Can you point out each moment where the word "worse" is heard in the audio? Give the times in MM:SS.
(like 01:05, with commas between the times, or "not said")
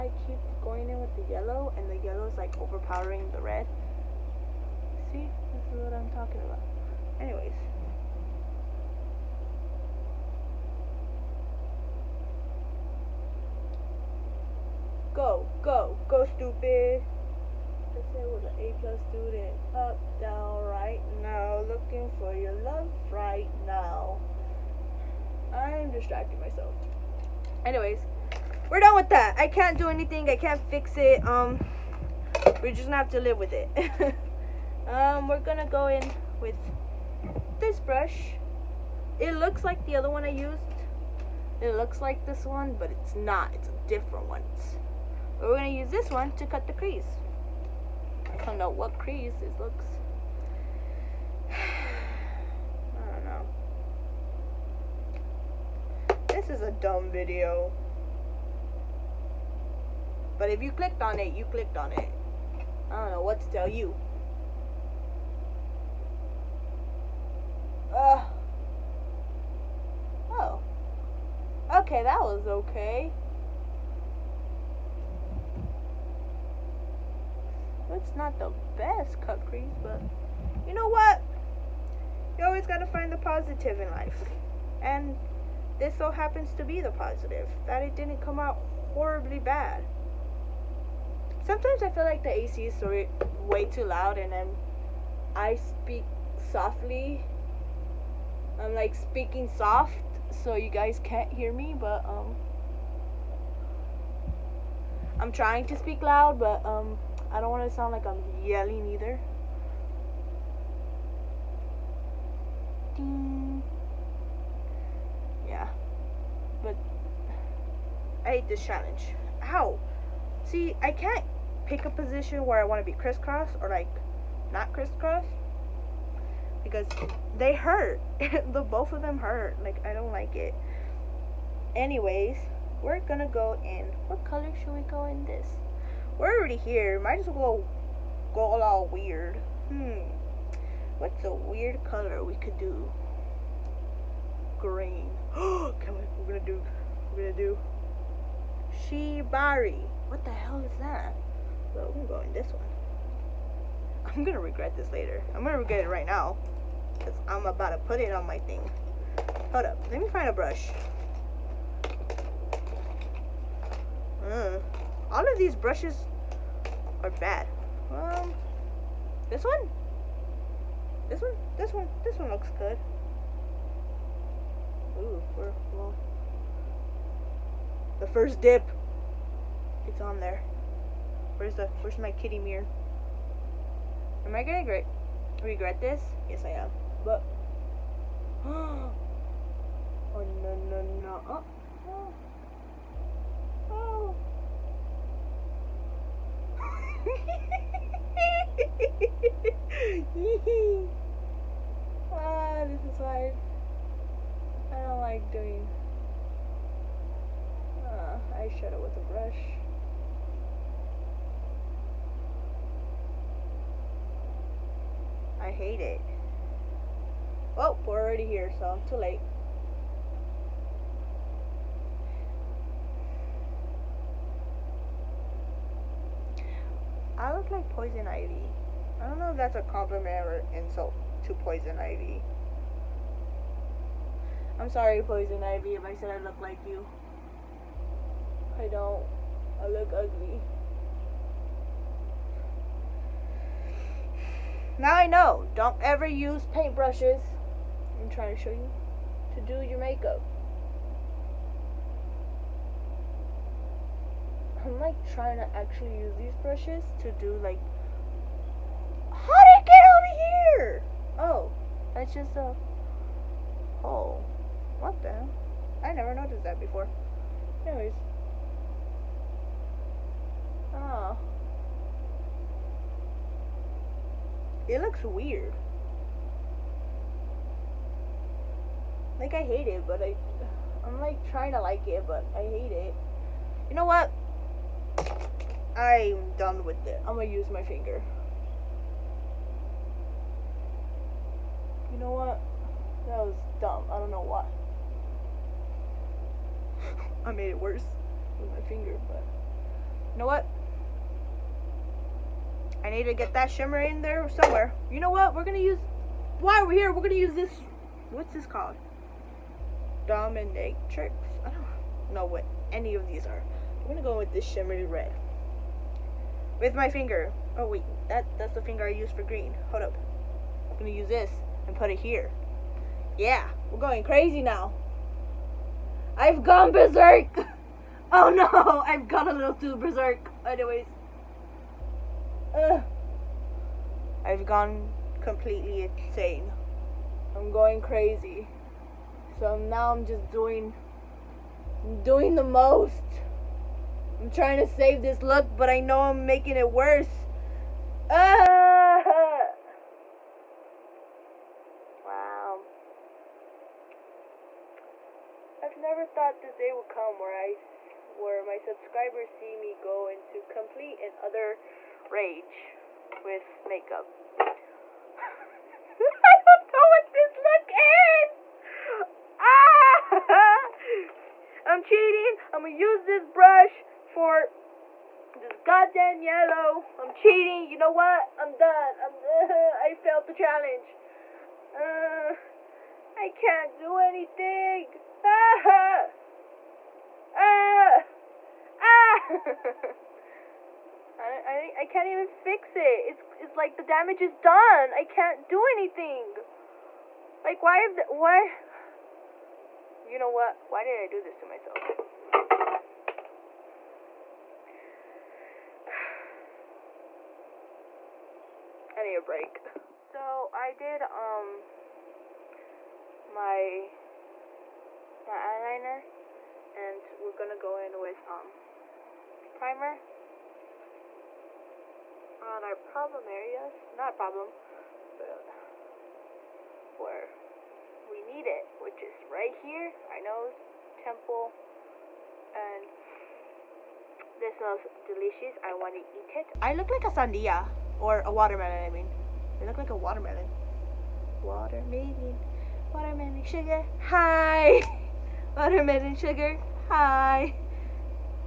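04:57, 05:46.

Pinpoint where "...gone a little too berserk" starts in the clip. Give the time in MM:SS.
05:29.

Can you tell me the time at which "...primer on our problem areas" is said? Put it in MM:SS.
06:59.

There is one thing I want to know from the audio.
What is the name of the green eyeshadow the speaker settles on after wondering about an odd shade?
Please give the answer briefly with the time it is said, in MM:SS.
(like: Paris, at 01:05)
Shibari, at 02:28.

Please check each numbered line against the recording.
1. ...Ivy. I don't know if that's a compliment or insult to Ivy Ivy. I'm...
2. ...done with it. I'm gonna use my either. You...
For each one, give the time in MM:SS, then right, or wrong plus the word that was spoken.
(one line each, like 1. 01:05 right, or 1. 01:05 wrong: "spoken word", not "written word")
1. 03:48 wrong: "Poison", not "Ivy"
2. 04:46 wrong: "finger", not "either".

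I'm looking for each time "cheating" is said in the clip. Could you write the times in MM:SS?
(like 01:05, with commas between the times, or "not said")
06:11, 06:17.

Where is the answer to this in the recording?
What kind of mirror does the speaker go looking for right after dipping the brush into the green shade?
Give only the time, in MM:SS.
03:02.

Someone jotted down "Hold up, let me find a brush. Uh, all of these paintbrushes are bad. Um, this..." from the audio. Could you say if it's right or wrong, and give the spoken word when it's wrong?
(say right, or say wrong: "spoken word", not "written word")
wrong: "brushes", not "paintbrushes".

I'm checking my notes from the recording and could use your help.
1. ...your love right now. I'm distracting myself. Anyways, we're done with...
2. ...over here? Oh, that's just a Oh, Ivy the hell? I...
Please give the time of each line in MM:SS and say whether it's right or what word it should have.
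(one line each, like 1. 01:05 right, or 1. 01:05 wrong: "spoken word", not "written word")
1. 00:22 right
2. 04:19 wrong: "What", not "Ivy".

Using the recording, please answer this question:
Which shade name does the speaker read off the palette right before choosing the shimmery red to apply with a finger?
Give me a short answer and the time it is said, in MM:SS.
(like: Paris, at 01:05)
Dominatrix, at 05:10.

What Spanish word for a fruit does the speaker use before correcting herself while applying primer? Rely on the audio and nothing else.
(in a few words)
sandia.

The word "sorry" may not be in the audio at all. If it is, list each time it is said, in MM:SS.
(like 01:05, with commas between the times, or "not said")
01:32, 03:54.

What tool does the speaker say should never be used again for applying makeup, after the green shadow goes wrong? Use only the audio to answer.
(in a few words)
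paintbrushes.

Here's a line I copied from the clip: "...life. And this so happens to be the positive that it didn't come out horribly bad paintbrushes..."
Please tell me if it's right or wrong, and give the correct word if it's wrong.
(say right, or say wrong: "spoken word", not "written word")
wrong: "sometimes", not "paintbrushes".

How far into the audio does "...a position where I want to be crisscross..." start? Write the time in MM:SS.
02:01.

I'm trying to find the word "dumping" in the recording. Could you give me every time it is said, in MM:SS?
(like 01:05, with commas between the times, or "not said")
not said.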